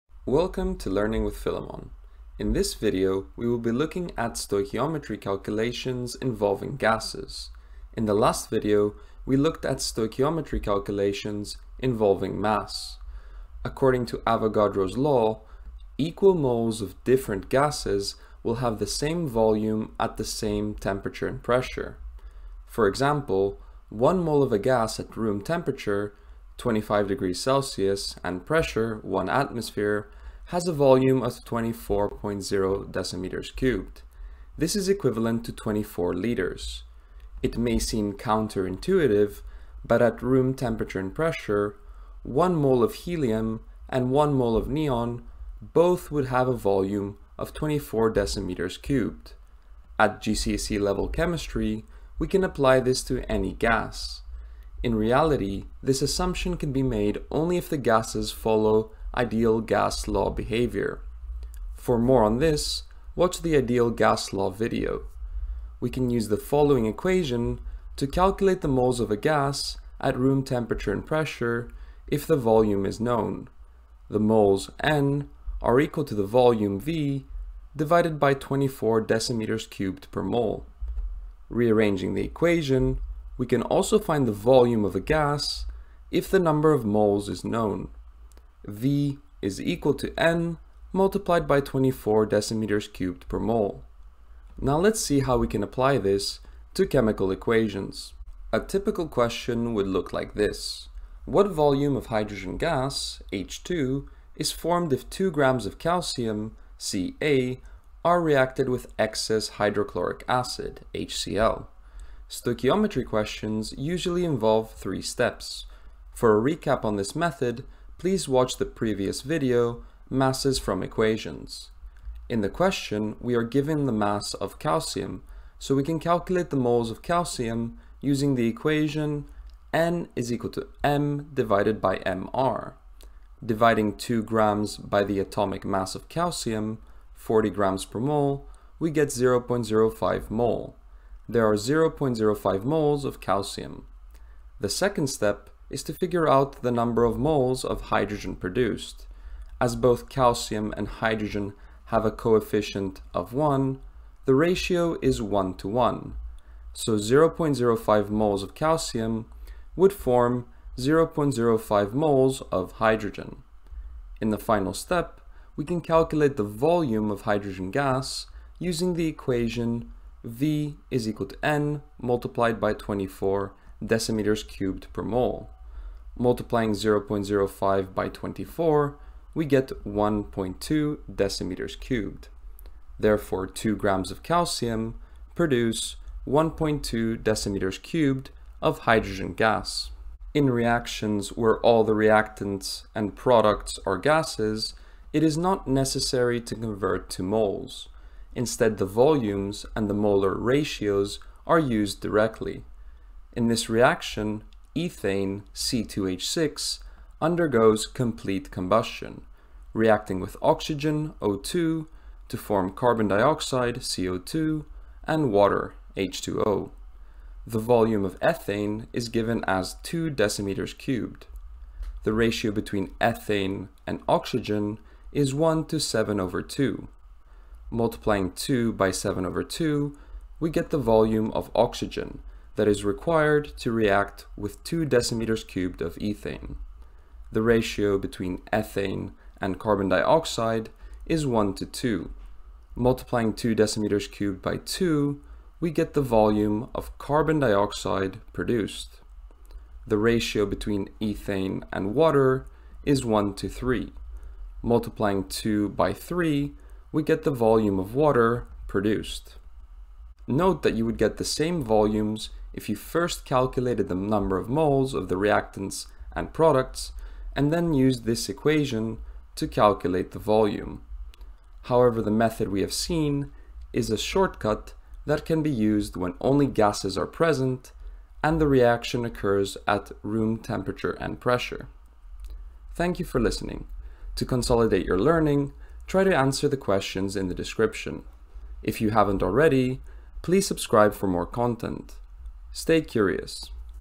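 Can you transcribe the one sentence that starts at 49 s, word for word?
At GCSE level chemistry, we can apply this to any gas.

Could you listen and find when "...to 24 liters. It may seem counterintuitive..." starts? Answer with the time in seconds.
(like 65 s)
35 s.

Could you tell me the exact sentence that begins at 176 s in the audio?
Multiplying 0.05 by 24, we get 1.2 decimeters cubed.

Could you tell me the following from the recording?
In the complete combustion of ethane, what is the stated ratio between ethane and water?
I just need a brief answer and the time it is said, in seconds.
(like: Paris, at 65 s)
1 to 3, at 253 s.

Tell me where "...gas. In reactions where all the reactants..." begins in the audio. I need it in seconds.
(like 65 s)
189 s.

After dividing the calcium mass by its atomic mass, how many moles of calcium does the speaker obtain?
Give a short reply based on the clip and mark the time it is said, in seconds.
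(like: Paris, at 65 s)
0.05, at 139 s.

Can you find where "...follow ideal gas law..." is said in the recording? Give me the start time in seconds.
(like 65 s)
58 s.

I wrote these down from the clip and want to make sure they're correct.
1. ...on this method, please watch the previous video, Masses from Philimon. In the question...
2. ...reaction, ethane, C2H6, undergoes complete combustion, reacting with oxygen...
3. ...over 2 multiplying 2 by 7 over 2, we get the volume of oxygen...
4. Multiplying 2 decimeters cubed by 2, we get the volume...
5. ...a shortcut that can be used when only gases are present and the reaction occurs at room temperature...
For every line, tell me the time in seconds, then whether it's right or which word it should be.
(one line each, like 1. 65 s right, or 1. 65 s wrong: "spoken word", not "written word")
1. 116 s wrong: "Equations", not "Philimon"
2. 203 s right
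3. 226 s right
4. 242 s right
5. 273 s right.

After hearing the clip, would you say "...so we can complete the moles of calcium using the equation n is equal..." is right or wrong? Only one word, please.
wrong.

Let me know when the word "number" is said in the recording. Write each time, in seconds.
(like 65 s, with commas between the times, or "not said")
86 s, 146 s, 263 s.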